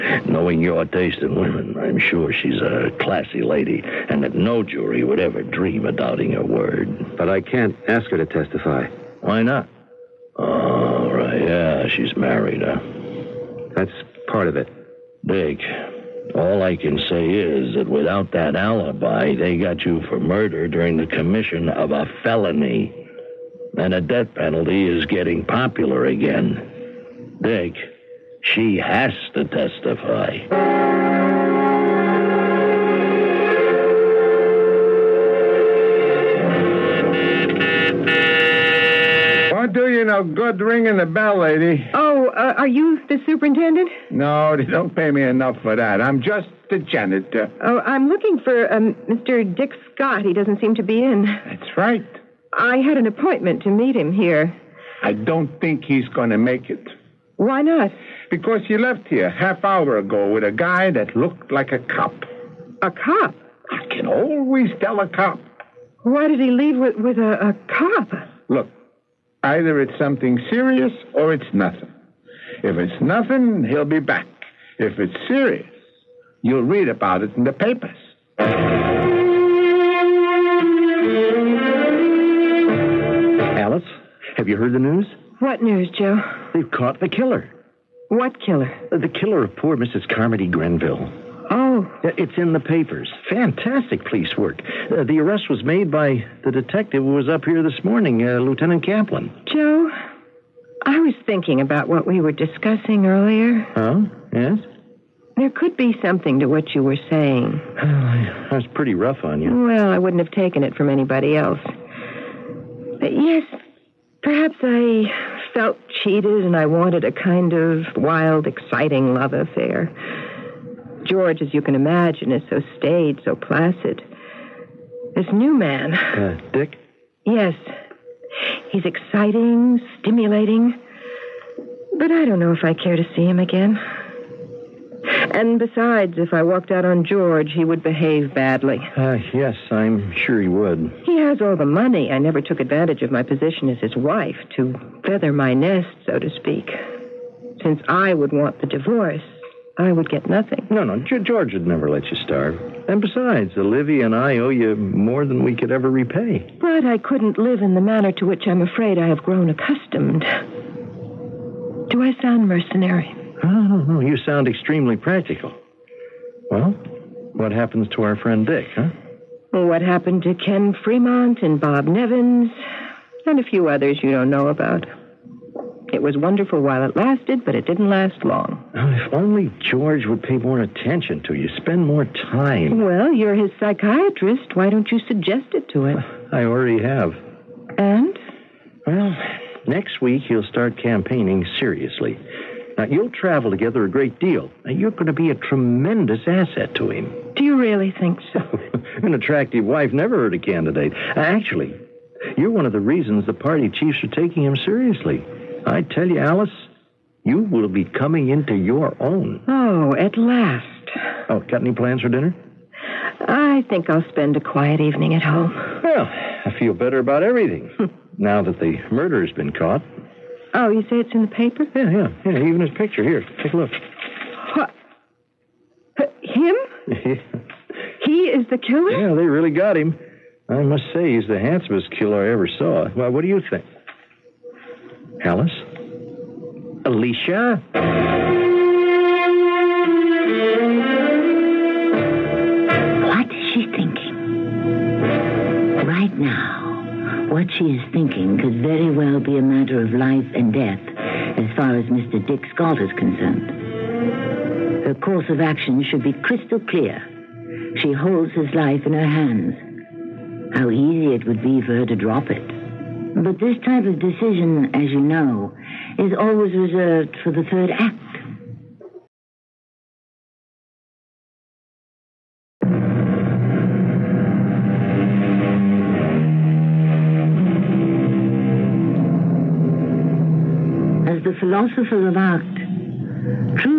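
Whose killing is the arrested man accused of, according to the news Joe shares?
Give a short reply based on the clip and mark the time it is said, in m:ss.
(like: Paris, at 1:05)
Mrs. Carmody Grenville, at 1:29.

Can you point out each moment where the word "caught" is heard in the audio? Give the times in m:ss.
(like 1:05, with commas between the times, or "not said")
1:26, 3:39.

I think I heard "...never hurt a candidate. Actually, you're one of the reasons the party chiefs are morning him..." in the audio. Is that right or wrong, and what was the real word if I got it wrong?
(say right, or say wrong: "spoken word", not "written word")
wrong: "taking", not "morning".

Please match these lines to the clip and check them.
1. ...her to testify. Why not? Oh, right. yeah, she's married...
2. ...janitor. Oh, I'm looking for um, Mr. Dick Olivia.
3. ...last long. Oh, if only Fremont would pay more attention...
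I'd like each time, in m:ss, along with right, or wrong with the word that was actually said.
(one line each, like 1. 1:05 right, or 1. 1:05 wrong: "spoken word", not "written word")
1. 0:08 right
2. 0:46 wrong: "Scott", not "Olivia"
3. 2:57 wrong: "George", not "Fremont".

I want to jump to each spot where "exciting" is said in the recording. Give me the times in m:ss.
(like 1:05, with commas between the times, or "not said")
1:58, 2:08.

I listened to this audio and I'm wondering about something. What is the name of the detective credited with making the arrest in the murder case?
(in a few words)
Lieutenant Kaplan.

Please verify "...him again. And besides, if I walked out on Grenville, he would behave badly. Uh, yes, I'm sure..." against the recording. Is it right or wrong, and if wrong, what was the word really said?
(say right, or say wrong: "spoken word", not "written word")
wrong: "George", not "Grenville".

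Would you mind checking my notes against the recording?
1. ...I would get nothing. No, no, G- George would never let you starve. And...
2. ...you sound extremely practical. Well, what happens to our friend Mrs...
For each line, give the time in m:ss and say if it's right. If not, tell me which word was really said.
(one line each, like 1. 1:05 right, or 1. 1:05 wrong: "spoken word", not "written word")
1. 2:29 right
2. 2:43 wrong: "Dick", not "Mrs".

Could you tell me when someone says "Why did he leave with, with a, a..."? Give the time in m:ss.
1:06.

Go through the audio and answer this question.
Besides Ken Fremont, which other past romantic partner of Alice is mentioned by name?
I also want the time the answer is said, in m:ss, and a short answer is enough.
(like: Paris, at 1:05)
Bob Nevins, at 2:51.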